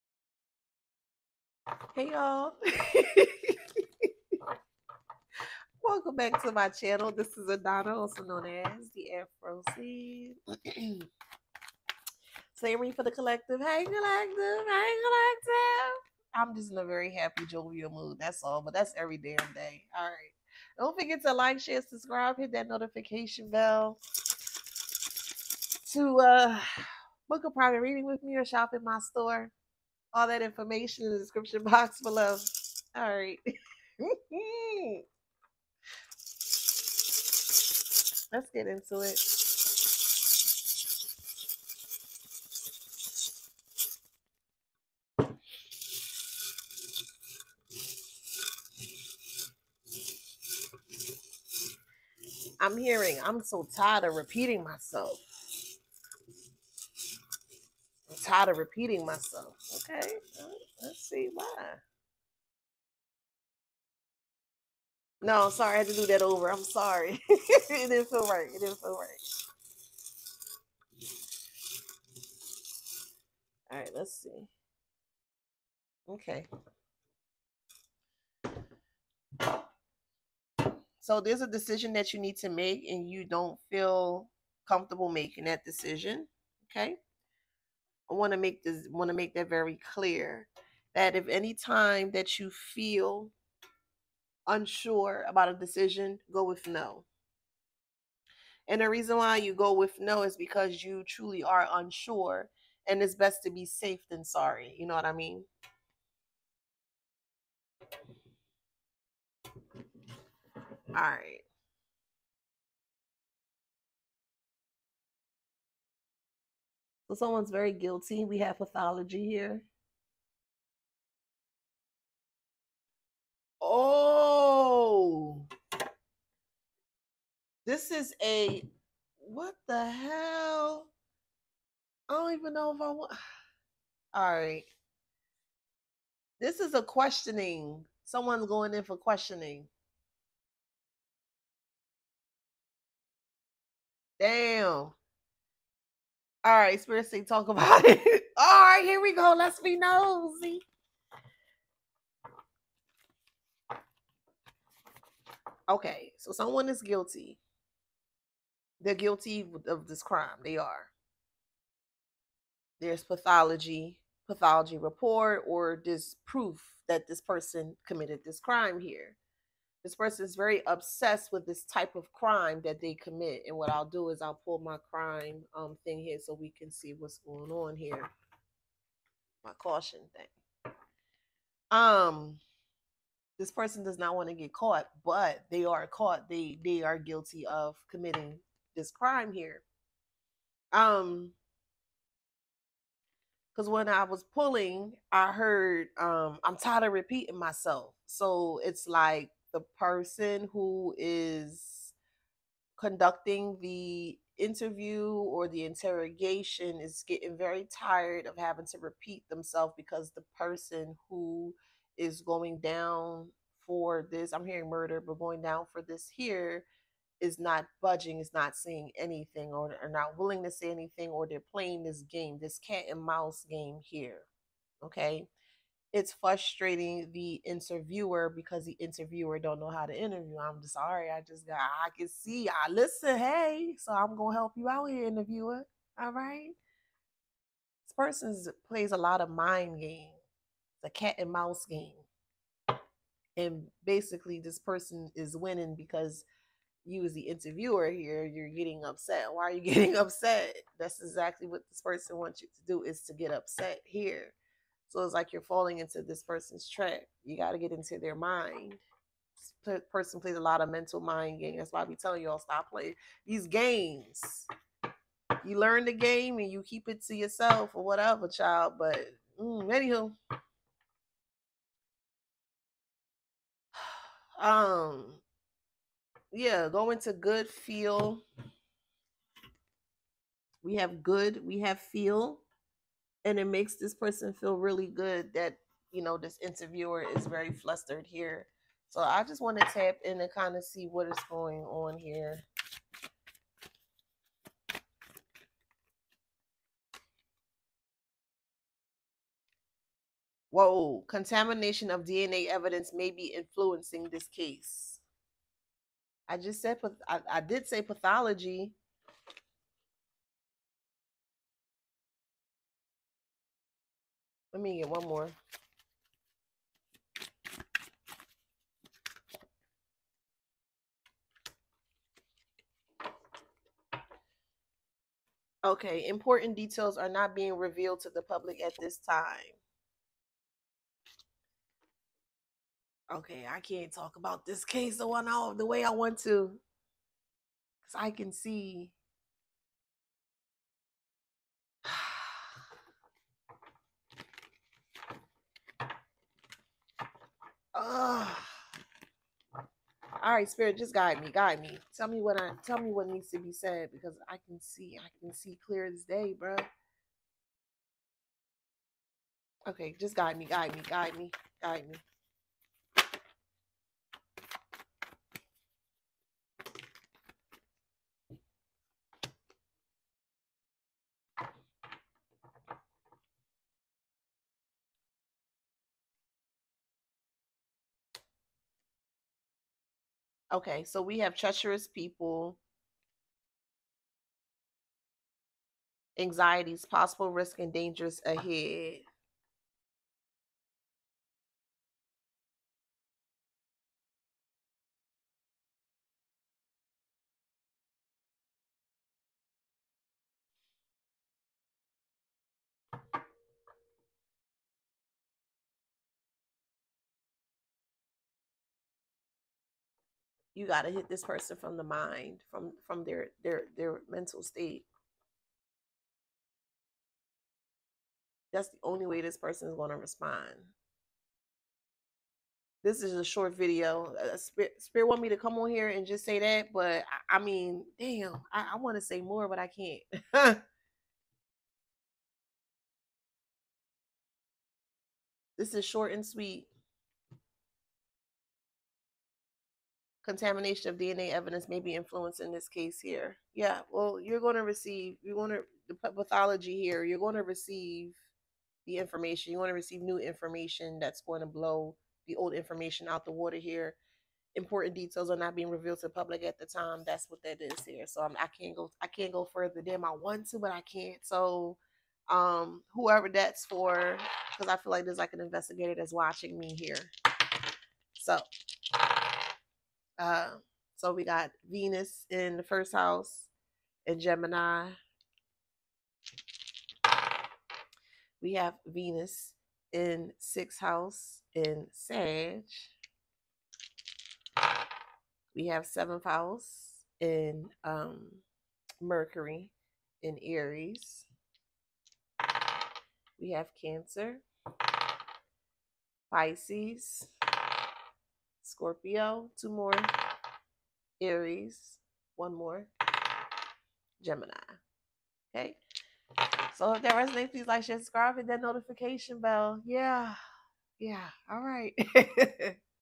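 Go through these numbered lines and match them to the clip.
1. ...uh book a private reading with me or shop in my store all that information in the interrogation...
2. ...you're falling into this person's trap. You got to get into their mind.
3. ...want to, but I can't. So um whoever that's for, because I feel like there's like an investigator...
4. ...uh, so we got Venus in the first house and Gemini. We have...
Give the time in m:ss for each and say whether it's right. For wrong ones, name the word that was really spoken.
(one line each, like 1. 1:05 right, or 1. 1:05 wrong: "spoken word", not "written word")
1. 0:26 wrong: "description", not "interrogation"
2. 4:15 right
3. 7:40 right
4. 7:50 right.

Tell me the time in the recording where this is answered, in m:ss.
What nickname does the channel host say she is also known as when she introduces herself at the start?
0:08.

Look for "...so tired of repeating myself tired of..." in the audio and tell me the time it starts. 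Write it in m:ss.
0:53.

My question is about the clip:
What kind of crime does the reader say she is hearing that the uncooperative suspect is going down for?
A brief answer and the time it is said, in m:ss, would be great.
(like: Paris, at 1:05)
Murder, at 3:34.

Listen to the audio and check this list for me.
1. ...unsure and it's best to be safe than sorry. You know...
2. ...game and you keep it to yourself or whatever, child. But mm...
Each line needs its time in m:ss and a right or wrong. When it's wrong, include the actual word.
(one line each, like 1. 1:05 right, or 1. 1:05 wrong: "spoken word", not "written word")
1. 1:41 right
2. 4:25 right.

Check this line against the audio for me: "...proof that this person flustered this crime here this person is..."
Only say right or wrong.
wrong.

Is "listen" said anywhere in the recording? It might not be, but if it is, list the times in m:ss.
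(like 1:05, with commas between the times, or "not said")
3:52.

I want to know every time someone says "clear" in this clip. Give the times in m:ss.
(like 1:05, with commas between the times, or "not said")
1:29, 5:55.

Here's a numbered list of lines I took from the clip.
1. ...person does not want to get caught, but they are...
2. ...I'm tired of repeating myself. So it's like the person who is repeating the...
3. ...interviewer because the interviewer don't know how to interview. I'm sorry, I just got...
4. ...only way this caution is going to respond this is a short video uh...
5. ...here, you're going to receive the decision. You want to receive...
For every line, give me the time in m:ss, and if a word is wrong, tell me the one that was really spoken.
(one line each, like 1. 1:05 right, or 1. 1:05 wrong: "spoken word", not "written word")
1. 3:03 right
2. 3:16 wrong: "conducting", not "repeating"
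3. 3:47 right
4. 6:58 wrong: "person", not "caution"
5. 7:26 wrong: "information", not "decision".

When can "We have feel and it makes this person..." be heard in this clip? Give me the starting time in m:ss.
4:41.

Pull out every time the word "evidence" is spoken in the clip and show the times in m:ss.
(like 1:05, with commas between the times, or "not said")
5:02, 7:21.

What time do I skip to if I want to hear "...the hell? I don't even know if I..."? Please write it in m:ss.
2:09.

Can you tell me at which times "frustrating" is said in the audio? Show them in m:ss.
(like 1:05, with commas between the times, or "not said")
3:46.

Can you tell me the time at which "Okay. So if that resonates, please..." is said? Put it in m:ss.
8:25.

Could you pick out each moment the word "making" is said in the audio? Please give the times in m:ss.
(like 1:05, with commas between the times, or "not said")
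1:25.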